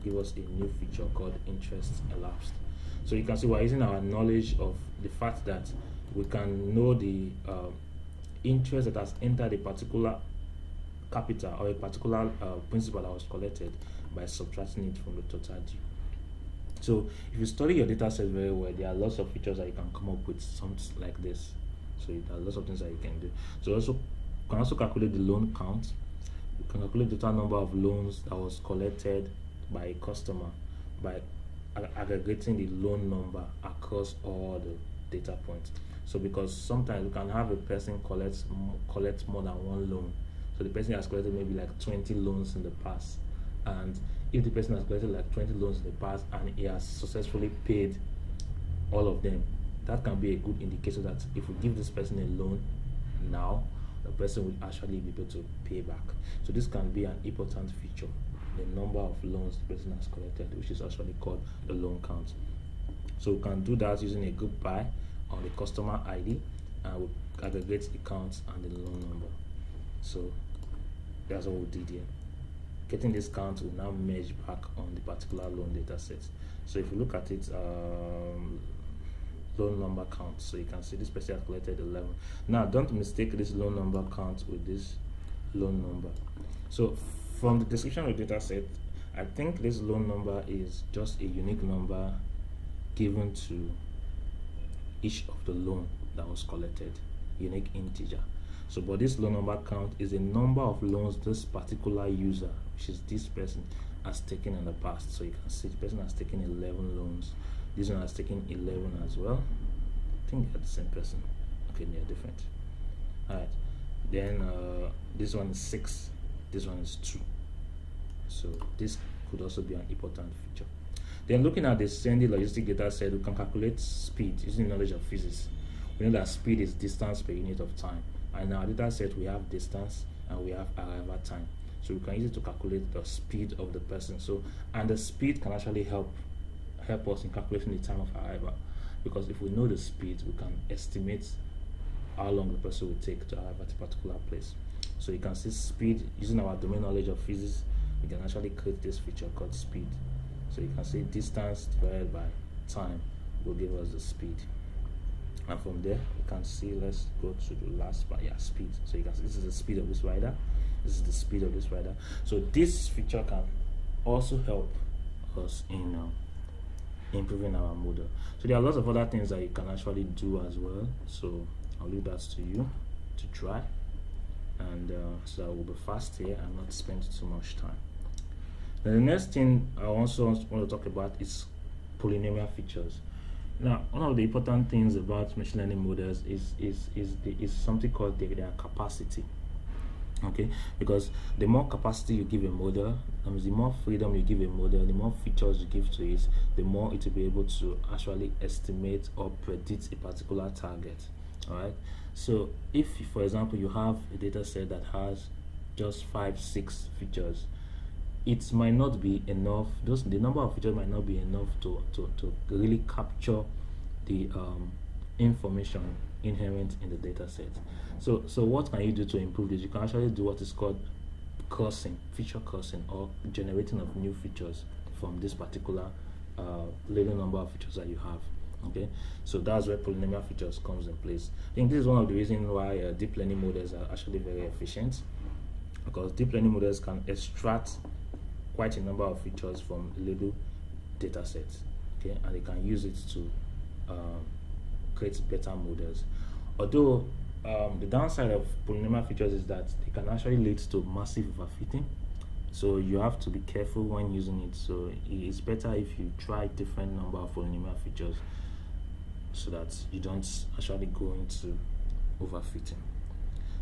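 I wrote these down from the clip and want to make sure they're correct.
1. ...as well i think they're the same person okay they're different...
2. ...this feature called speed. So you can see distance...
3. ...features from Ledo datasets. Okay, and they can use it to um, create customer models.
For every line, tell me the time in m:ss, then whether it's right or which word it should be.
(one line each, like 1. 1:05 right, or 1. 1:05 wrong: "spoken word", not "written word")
1. 1:49 right
2. 2:28 right
3. 3:59 wrong: "better", not "customer".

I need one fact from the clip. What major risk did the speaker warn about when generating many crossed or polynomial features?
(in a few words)
massive overfitting.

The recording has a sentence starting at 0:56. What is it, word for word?
So this can be an important feature, the number of loans the person has collected, which is actually called the loan count.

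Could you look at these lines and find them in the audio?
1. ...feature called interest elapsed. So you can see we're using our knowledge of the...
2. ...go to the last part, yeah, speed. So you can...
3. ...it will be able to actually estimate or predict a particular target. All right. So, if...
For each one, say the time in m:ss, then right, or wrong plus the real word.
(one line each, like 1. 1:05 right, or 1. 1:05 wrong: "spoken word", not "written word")
1. 0:00 right
2. 2:37 right
3. 3:16 right.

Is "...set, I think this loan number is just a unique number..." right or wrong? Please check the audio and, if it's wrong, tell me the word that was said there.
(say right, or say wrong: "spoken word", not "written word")
right.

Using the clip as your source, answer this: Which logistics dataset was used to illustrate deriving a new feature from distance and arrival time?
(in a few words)
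Sendy.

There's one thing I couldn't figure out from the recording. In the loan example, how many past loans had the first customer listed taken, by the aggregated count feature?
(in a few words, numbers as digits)
11.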